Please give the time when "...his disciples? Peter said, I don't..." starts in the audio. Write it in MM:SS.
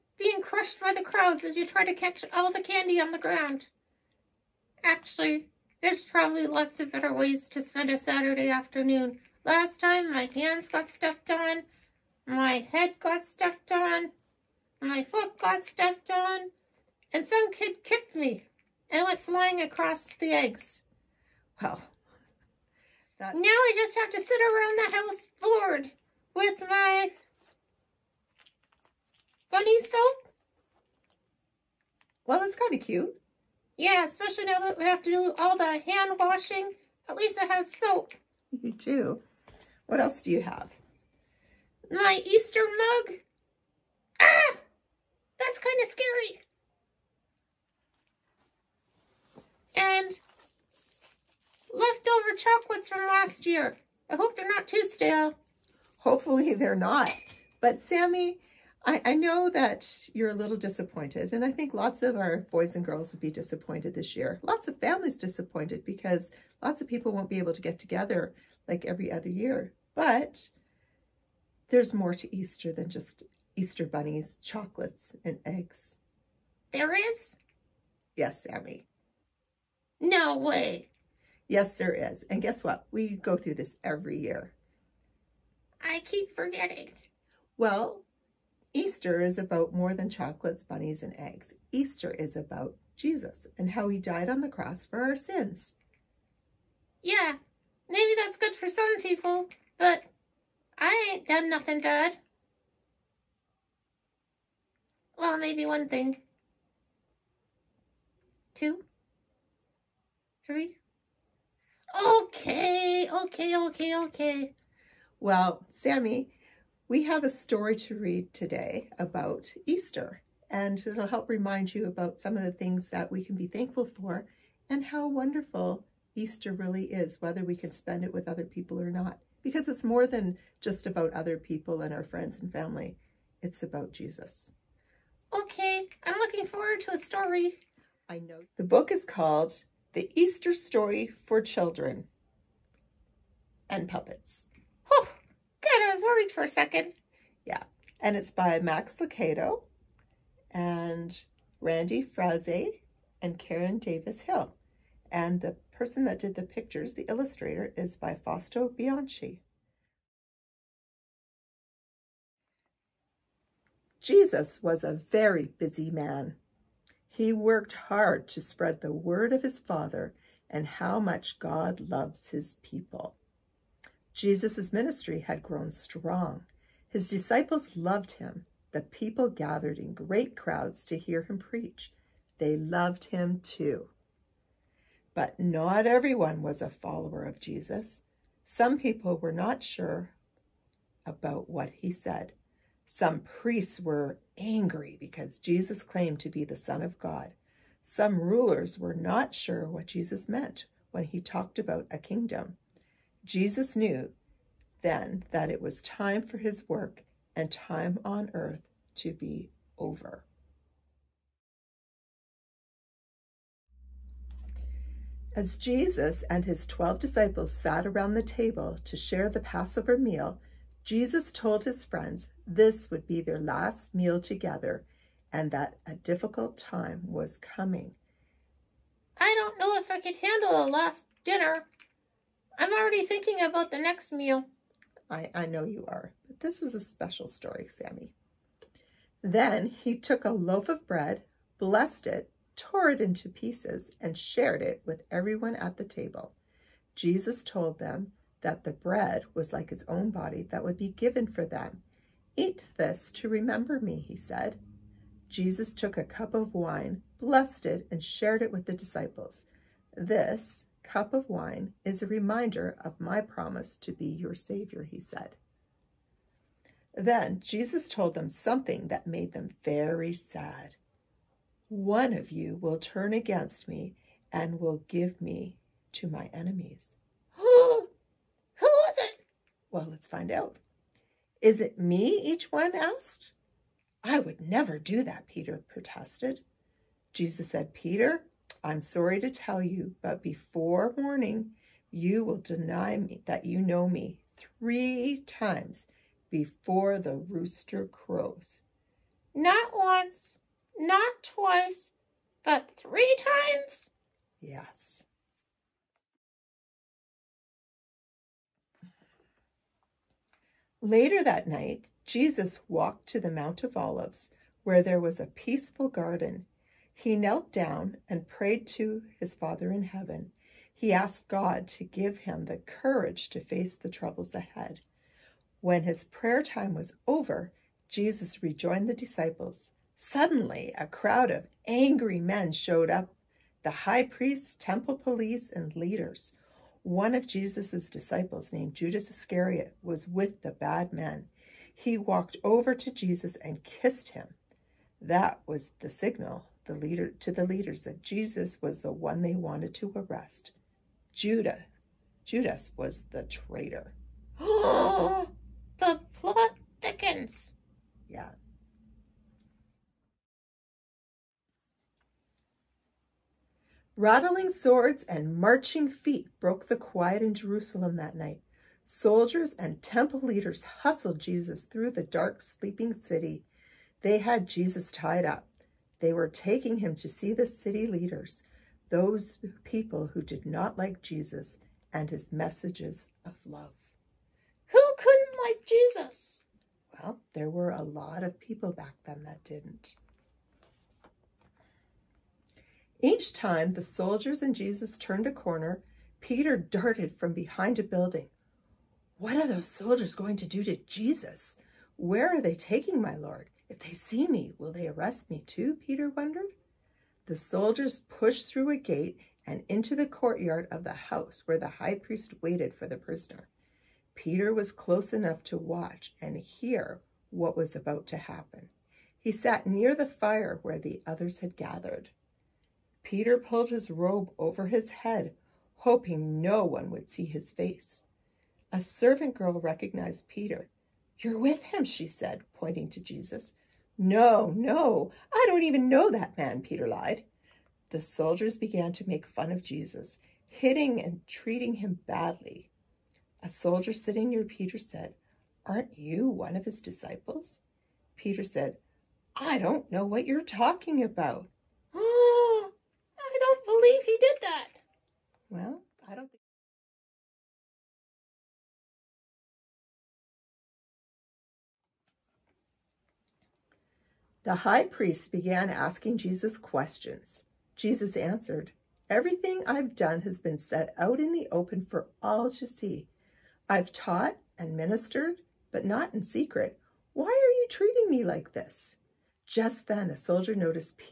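07:26.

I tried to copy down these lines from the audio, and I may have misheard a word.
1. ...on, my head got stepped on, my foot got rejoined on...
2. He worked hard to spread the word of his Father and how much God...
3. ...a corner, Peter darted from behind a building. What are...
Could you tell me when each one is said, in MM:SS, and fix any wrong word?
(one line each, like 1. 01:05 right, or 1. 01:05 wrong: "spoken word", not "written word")
1. 00:11 wrong: "stepped", not "rejoined"
2. 02:47 right
3. 06:35 right.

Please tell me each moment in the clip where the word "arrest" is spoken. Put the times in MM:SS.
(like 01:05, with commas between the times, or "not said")
05:49, 06:44.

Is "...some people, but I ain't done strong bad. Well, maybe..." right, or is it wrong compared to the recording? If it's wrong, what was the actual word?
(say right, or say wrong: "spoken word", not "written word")
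wrong: "nothing", not "strong".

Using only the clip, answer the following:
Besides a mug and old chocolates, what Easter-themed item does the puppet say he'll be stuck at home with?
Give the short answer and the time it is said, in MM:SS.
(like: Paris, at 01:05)
bunny soap, at 00:29.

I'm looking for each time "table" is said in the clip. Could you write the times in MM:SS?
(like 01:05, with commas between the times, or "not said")
03:38, 04:05.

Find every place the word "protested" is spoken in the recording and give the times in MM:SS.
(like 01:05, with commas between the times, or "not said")
04:45.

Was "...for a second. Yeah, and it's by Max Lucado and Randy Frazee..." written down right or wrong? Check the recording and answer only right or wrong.
right.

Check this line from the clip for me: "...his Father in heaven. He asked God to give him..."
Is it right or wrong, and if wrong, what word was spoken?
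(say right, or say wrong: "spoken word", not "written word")
right.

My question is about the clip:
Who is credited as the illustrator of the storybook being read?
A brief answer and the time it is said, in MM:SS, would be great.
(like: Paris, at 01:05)
Fausto Bianchi, at 02:38.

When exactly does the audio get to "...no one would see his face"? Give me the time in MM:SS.
07:06.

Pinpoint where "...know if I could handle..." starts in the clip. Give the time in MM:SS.
03:49.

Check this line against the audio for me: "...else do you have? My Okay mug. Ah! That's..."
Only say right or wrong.
wrong.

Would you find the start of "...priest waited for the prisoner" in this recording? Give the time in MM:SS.
06:51.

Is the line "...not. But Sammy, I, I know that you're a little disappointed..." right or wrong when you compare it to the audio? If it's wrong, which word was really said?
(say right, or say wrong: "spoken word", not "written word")
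right.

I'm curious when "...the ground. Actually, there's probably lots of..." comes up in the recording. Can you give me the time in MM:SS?
00:03.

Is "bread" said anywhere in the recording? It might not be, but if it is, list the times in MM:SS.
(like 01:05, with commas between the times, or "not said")
04:00, 04:08.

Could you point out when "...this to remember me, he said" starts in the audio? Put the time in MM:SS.
04:12.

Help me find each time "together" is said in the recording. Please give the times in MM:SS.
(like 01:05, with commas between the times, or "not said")
01:07, 03:44.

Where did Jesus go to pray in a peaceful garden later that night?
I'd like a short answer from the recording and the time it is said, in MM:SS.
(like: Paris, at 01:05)
Mount of Olives, at 05:13.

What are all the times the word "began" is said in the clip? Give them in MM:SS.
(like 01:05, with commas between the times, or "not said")
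07:18, 07:45.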